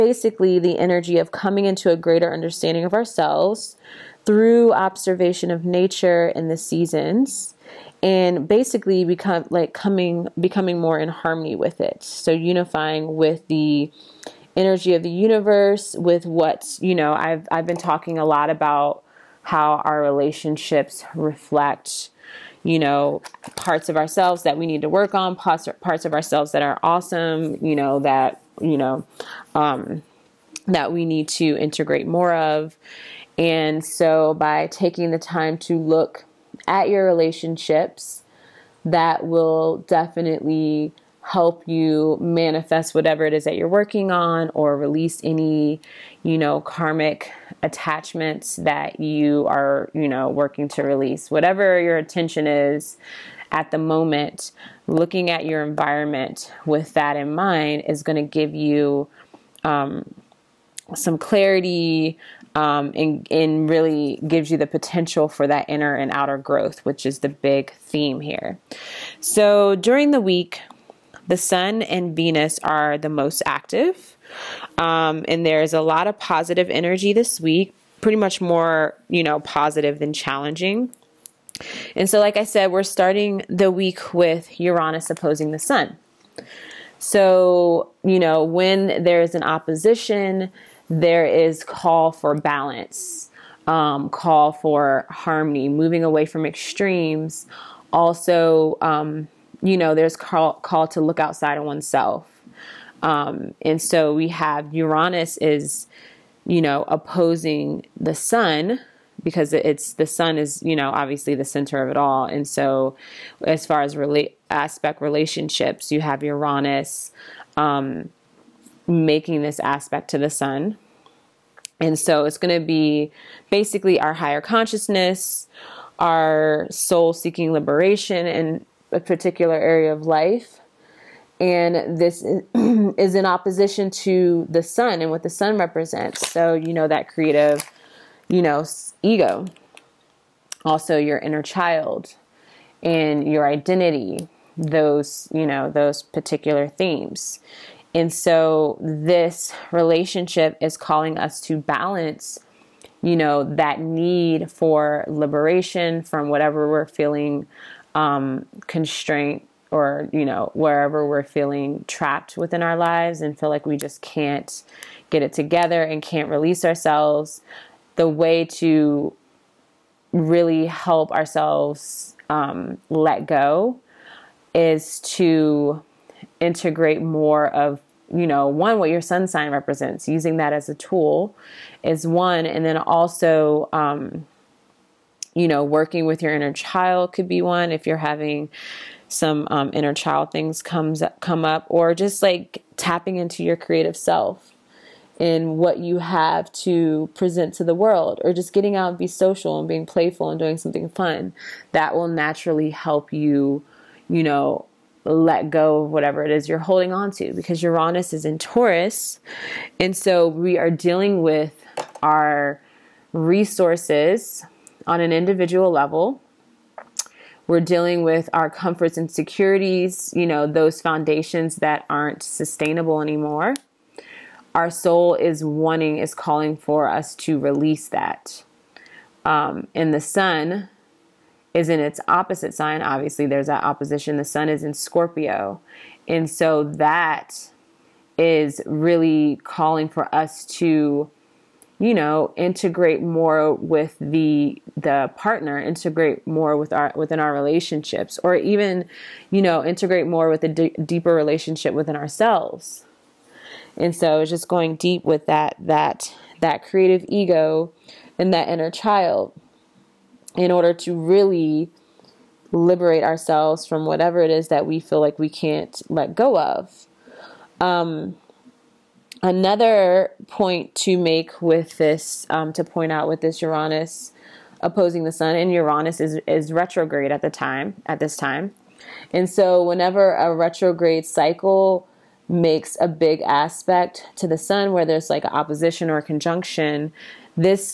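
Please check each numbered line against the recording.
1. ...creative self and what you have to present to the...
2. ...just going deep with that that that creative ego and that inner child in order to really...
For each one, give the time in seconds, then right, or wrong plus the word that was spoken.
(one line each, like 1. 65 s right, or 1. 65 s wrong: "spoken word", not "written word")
1. 193 s right
2. 254 s right.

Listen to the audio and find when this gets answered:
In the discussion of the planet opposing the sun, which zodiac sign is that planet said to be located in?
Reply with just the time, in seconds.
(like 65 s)
208 s.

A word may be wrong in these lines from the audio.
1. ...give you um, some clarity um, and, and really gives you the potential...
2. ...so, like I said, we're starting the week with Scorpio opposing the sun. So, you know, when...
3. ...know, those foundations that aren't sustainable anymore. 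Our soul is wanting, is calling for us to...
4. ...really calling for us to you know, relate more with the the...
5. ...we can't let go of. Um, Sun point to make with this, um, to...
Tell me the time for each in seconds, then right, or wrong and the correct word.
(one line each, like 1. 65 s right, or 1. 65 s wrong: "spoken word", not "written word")
1. 58 s right
2. 82 s wrong: "Uranus", not "Scorpio"
3. 220 s right
4. 238 s wrong: "integrate", not "relate"
5. 265 s wrong: "Another", not "Sun".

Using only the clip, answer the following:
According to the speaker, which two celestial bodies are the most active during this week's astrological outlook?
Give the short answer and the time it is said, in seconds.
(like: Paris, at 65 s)
The Sun and Venus, at 71 s.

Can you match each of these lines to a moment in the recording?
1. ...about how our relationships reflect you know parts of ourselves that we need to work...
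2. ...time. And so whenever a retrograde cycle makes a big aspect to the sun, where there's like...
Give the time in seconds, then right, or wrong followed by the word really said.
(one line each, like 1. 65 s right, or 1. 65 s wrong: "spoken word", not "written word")
1. 18 s right
2. 278 s right.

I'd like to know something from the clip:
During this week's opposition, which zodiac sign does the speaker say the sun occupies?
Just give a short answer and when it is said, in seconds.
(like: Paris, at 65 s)
Scorpio, at 234 s.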